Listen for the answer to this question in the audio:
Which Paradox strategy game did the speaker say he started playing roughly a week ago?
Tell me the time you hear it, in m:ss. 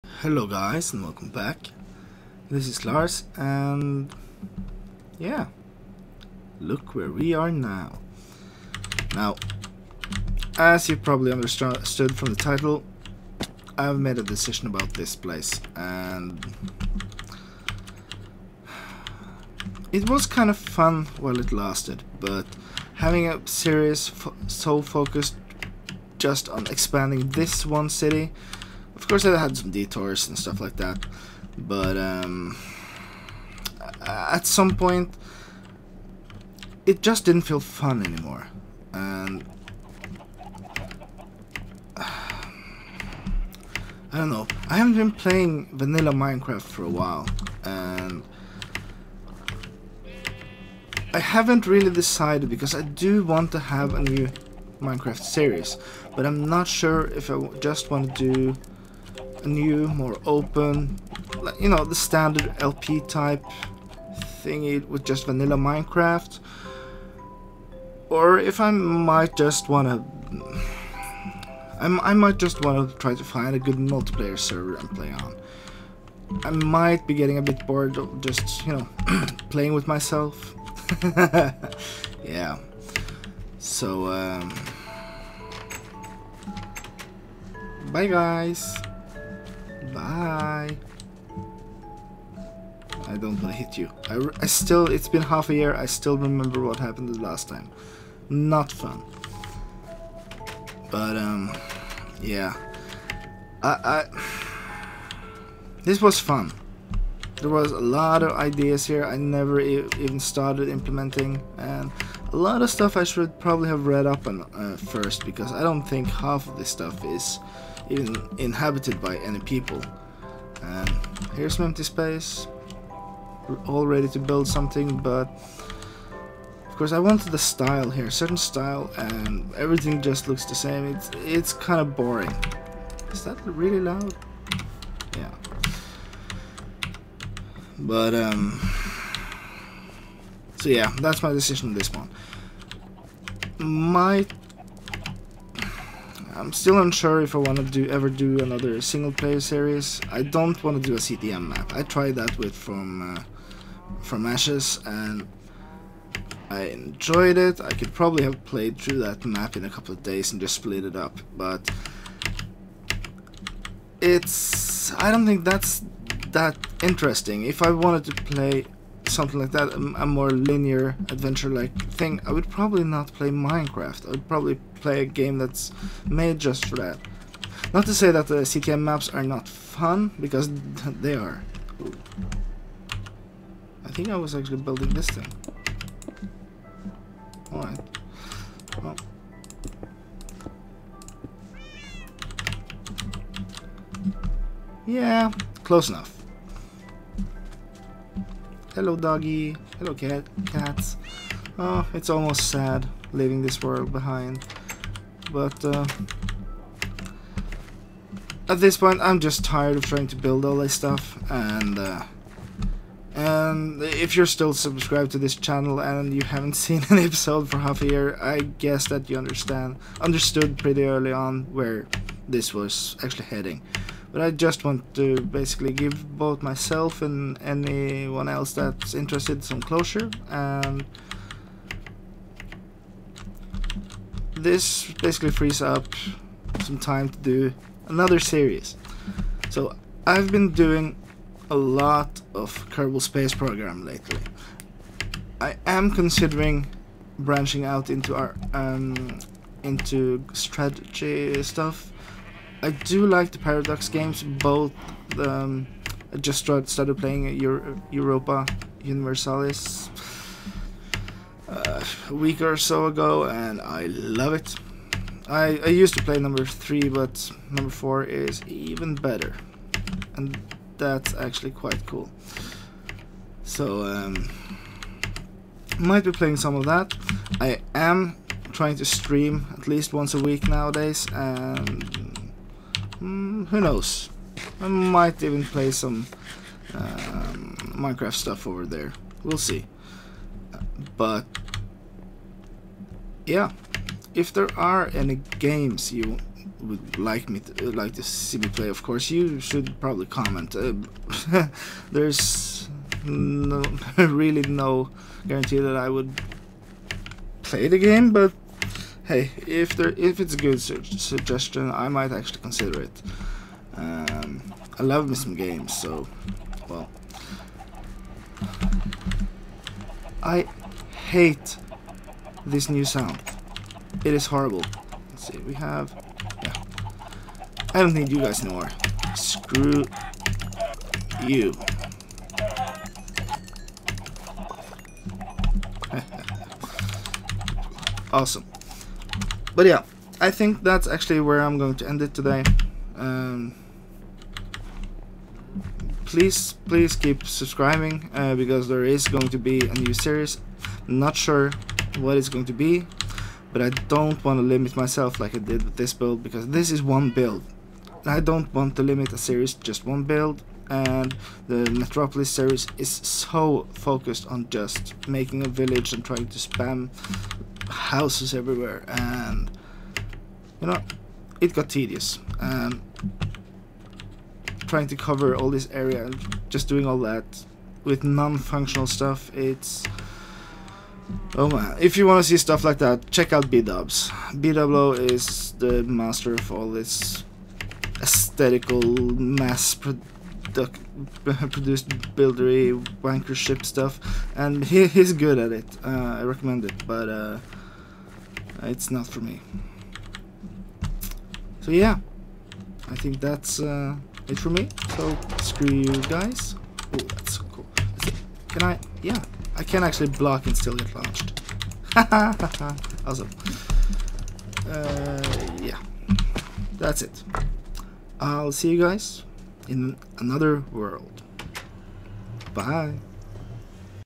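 4:17.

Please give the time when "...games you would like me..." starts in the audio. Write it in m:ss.
4:55.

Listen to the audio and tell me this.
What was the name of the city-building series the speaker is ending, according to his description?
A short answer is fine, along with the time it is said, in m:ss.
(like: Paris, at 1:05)
Metropolis, at 6:01.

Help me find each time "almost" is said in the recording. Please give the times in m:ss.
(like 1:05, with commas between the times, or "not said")
3:22.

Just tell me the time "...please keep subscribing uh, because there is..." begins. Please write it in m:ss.
5:46.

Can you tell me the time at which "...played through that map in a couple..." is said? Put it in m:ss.
2:38.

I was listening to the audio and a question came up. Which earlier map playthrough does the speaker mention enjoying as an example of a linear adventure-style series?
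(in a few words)
From Ashes.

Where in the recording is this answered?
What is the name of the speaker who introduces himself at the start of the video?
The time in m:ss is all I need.
0:02.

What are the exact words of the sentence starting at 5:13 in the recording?
Um, I love me some games, so well.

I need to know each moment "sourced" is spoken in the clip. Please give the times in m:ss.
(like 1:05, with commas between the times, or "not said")
not said.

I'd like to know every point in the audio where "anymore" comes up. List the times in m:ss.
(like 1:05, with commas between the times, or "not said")
0:38, 5:28.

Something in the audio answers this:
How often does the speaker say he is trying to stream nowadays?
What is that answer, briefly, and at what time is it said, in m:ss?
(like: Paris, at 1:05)
once a week, at 4:39.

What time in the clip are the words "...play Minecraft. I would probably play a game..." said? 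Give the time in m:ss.
2:53.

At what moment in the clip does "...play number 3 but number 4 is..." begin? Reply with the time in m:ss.
4:26.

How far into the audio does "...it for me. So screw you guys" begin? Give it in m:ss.
6:44.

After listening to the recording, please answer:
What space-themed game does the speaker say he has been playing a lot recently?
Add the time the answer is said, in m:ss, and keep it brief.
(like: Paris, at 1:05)
Kerbal Space Program, at 4:02.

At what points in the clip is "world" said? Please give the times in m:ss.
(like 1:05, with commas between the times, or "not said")
3:23, 7:00.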